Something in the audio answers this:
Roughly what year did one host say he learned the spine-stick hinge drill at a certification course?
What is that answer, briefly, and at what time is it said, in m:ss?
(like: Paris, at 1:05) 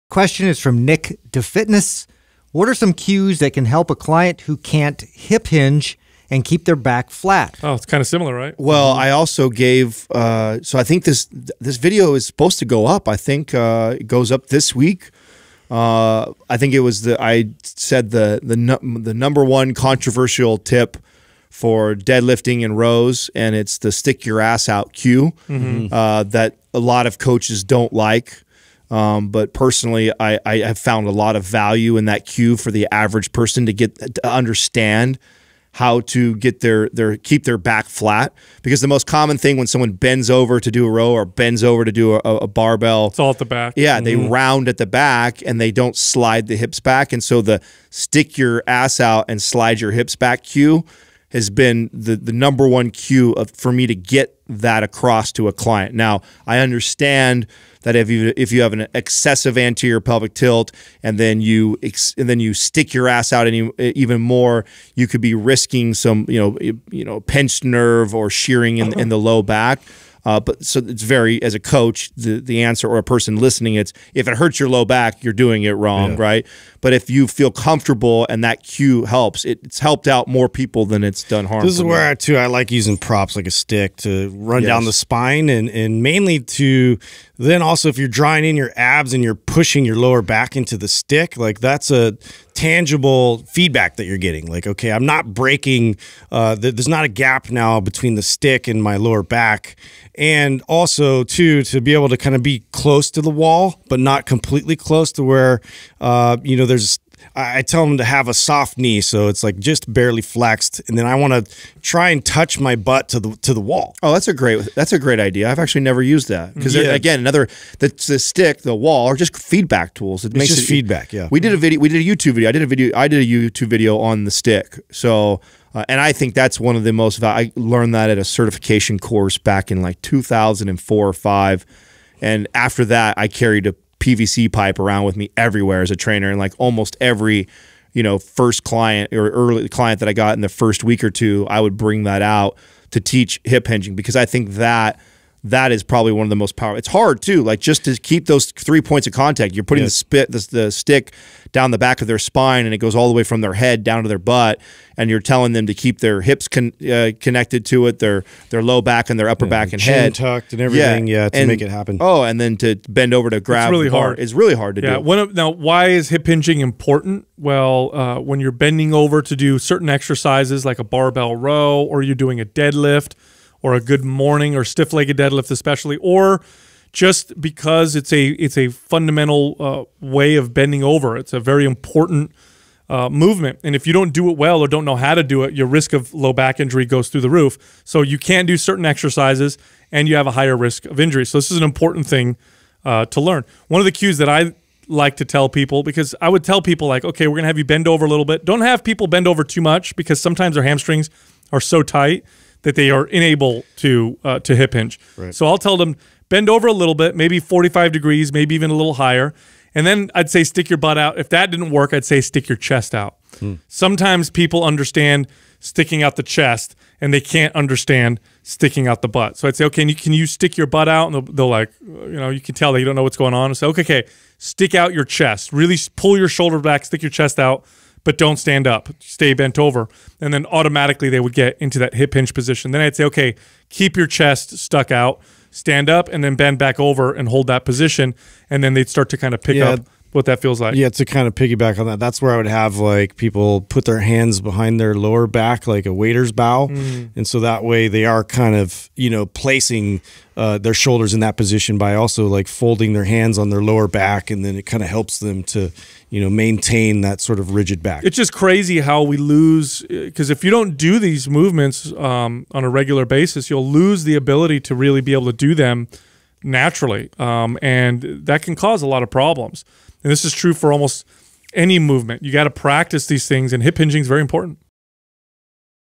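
2004, at 2:10.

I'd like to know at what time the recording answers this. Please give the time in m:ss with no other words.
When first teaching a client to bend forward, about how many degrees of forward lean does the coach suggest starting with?
3:27.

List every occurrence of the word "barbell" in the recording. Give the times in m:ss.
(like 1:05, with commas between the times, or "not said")
0:42, 2:50.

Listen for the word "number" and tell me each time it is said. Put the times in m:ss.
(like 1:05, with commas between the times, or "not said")
0:19, 0:52.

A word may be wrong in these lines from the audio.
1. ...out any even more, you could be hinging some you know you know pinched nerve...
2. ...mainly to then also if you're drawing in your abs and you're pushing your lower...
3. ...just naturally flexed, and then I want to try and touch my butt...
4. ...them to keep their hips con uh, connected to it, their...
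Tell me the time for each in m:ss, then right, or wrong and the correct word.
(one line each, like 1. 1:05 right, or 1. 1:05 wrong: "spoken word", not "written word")
1. 1:03 wrong: "risking", not "hinging"
2. 1:26 right
3. 1:49 wrong: "barely", not "naturally"
4. 2:35 right.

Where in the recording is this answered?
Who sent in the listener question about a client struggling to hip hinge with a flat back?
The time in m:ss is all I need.
0:00.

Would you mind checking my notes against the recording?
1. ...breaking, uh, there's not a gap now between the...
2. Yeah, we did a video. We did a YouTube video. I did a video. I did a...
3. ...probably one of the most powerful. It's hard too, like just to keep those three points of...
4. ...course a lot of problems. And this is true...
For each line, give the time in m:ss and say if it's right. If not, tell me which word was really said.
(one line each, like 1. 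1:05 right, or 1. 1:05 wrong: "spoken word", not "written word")
1. 1:35 right
2. 2:01 right
3. 2:25 right
4. 4:28 wrong: "cause", not "course".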